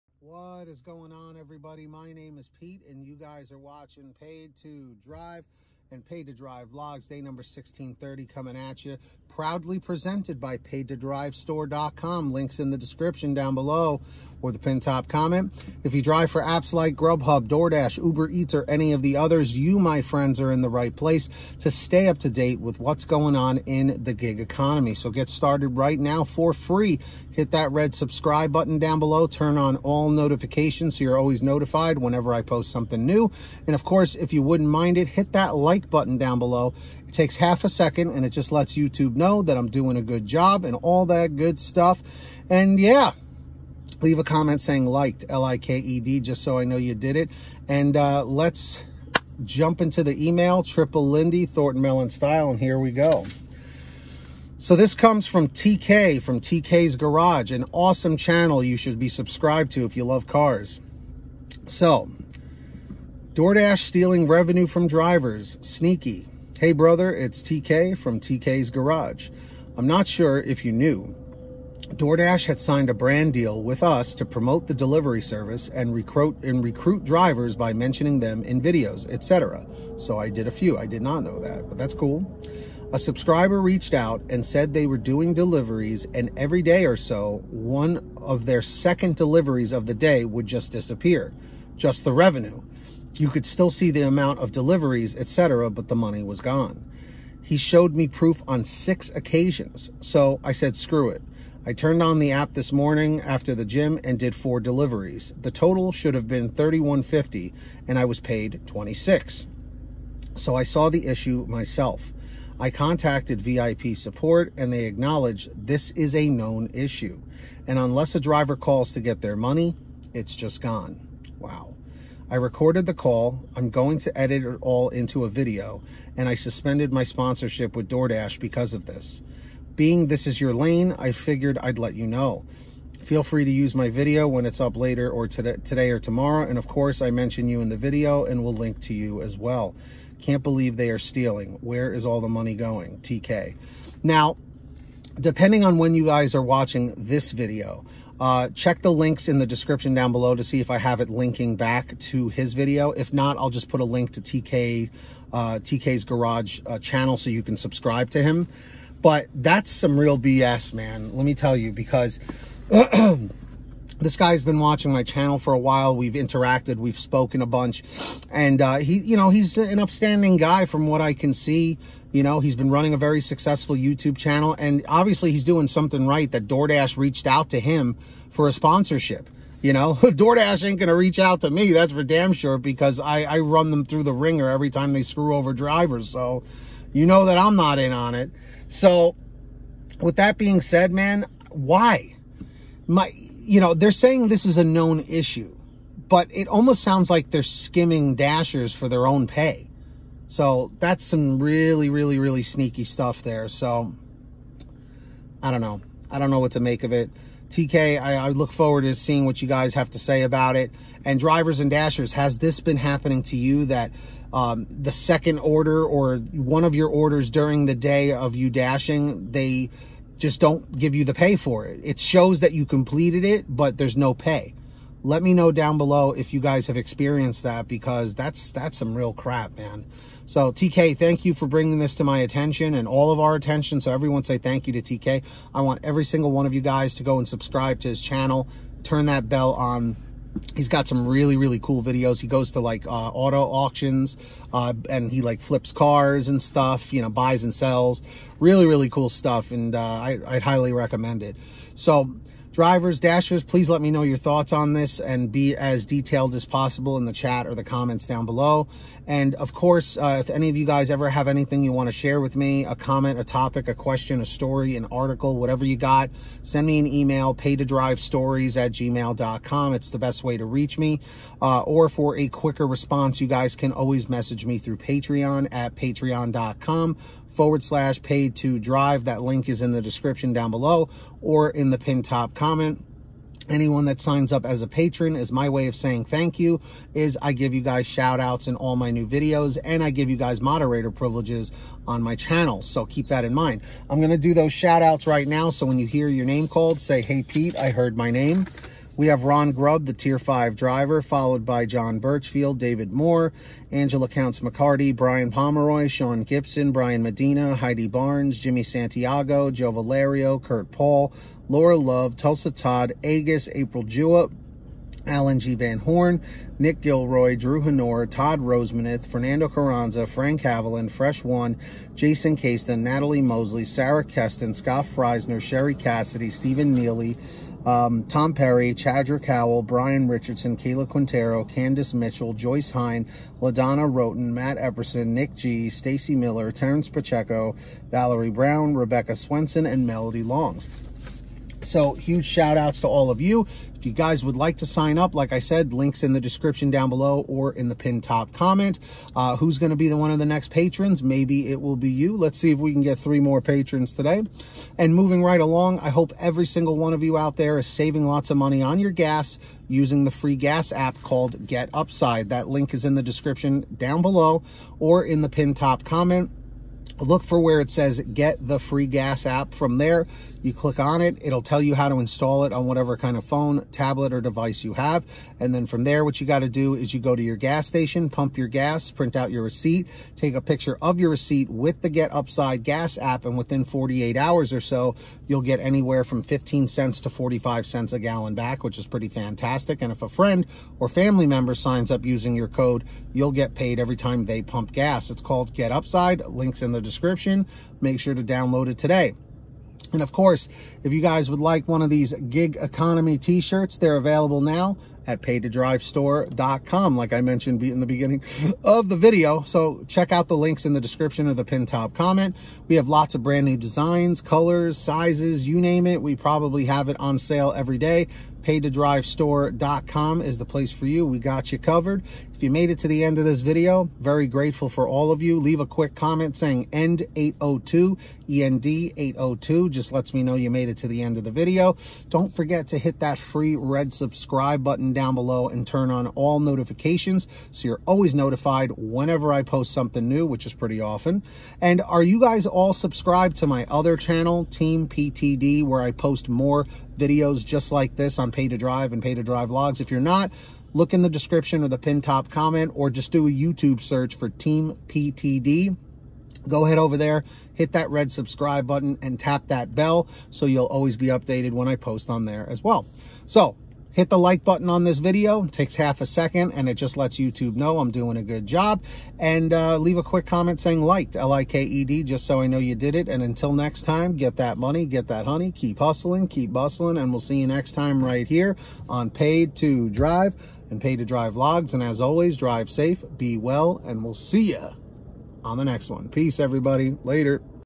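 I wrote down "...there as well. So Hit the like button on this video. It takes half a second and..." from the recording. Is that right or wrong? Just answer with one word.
right.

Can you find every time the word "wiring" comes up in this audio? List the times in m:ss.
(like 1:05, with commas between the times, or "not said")
not said.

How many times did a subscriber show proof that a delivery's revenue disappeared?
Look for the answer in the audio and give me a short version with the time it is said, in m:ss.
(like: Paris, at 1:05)
6, at 1:38.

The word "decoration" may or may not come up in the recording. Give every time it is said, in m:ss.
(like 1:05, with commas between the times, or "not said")
not said.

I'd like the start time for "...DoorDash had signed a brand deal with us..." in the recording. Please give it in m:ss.
1:11.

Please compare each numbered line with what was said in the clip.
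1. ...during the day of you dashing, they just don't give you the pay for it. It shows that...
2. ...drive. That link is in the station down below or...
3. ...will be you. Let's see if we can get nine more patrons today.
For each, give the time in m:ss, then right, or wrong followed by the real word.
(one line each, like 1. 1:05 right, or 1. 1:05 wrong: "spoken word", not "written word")
1. 3:37 right
2. 4:38 wrong: "description", not "station"
3. 5:51 wrong: "three", not "nine".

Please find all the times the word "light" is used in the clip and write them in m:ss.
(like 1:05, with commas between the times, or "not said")
not said.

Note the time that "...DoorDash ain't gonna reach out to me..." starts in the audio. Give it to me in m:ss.
2:59.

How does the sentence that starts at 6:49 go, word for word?
So check out the links in the description of the pin top comment.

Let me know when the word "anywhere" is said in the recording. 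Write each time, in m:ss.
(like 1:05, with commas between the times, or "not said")
6:25.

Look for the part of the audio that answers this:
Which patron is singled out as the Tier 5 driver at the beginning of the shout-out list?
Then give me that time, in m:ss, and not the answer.
4:59.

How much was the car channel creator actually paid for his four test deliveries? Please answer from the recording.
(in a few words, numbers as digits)
$26.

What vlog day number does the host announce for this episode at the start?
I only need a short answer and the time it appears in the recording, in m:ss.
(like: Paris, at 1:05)
1630, at 0:07.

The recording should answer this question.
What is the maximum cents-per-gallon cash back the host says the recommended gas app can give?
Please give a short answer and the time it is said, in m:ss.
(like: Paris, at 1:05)
45 cents, at 6:27.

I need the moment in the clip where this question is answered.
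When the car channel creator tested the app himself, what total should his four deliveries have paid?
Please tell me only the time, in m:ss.
1:46.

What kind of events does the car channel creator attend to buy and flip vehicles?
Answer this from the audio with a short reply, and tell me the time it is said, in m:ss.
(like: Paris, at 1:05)
auto auctions, at 4:02.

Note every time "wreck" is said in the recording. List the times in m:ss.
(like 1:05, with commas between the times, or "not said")
not said.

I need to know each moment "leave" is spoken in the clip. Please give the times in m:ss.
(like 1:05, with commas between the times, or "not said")
0:44, 7:05, 7:49.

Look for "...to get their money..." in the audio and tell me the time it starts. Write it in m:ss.
1:58.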